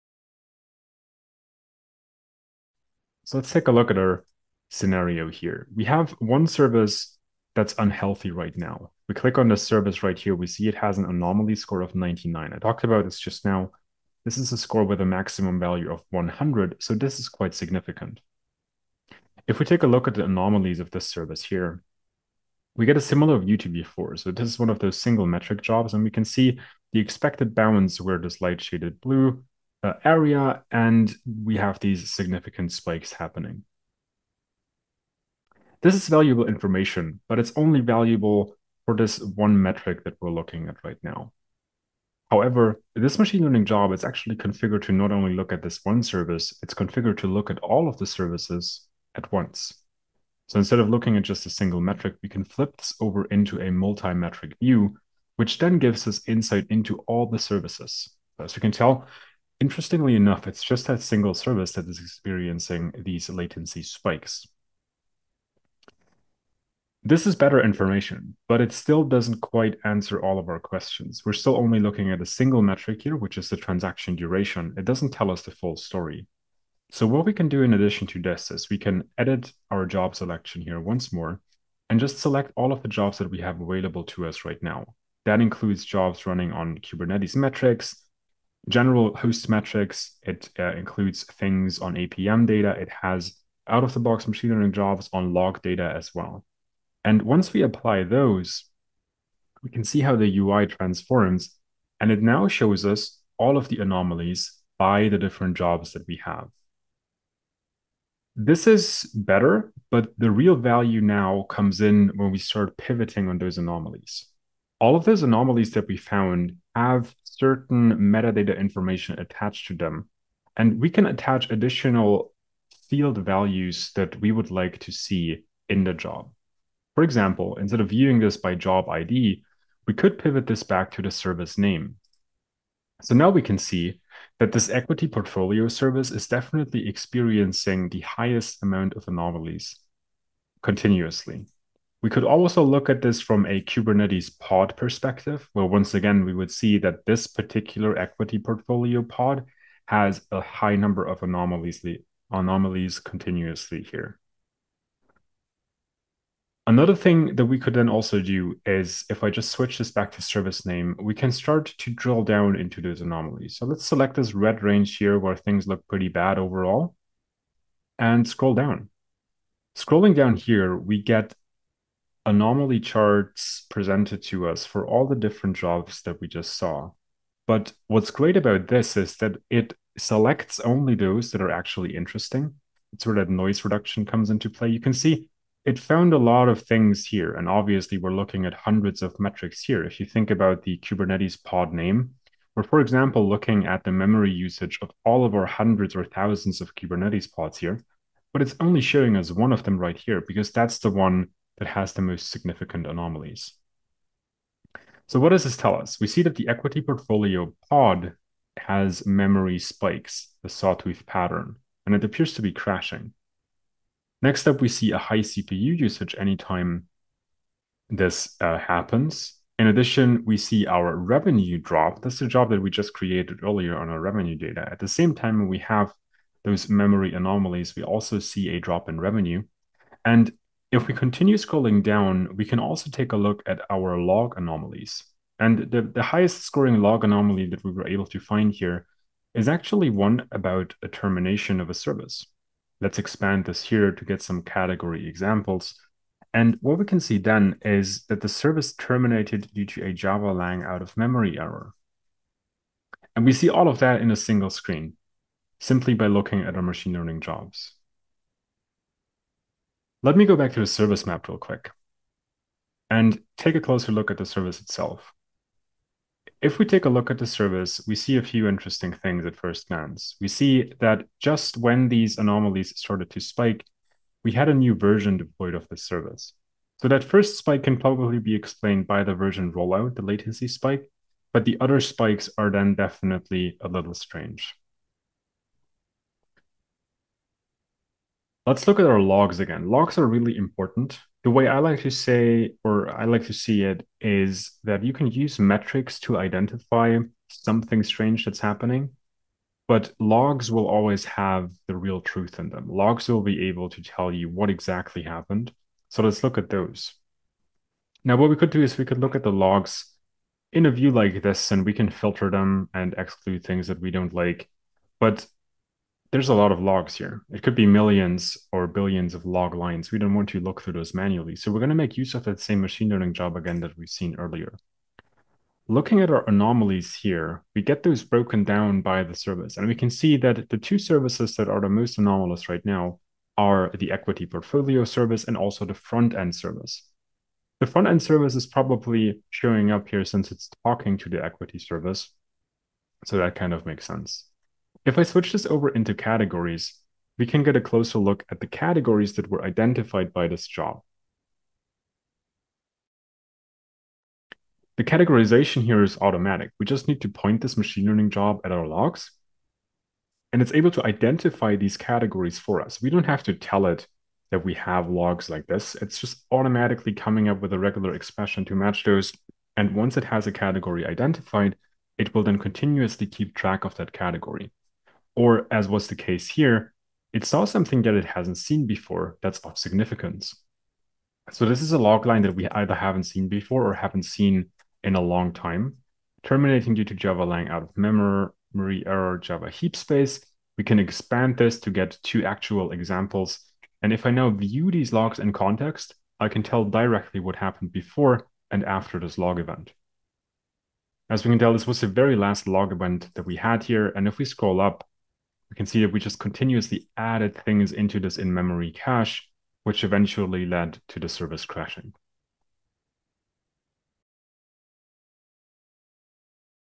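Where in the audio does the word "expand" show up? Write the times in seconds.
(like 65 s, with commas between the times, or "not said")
242 s, 390 s.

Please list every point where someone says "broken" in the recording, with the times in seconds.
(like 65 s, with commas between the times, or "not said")
328 s.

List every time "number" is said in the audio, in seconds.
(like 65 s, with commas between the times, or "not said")
150 s.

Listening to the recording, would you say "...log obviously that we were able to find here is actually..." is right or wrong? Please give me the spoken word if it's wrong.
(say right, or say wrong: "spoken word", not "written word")
wrong: "anomaly", not "obviously".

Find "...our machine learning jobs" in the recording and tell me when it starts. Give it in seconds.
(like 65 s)
256 s.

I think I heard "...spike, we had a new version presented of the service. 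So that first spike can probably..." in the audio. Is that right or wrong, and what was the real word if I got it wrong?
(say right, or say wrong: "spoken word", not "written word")
wrong: "deployed", not "presented".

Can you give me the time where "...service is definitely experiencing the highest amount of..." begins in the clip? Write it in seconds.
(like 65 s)
135 s.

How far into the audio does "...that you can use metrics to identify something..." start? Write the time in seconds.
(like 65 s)
294 s.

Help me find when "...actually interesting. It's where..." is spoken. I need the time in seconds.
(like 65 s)
181 s.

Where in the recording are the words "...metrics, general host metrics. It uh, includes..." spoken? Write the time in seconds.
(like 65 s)
87 s.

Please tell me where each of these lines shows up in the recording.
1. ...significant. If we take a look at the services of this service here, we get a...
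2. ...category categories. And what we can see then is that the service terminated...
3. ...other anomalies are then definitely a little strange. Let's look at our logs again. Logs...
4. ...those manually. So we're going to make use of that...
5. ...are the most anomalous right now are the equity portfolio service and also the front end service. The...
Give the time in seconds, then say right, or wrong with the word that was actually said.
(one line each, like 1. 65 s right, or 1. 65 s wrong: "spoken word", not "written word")
1. 17 s wrong: "anomalies", not "services"
2. 244 s wrong: "examples", not "categories"
3. 281 s wrong: "spikes", not "anomalies"
4. 320 s right
5. 331 s right.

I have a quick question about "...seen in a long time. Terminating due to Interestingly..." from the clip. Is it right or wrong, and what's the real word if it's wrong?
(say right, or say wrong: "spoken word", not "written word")
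wrong: "Java", not "Interestingly".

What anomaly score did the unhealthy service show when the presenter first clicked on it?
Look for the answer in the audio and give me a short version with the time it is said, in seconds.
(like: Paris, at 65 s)
99, at 11 s.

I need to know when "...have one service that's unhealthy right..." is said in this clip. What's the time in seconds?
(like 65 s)
5 s.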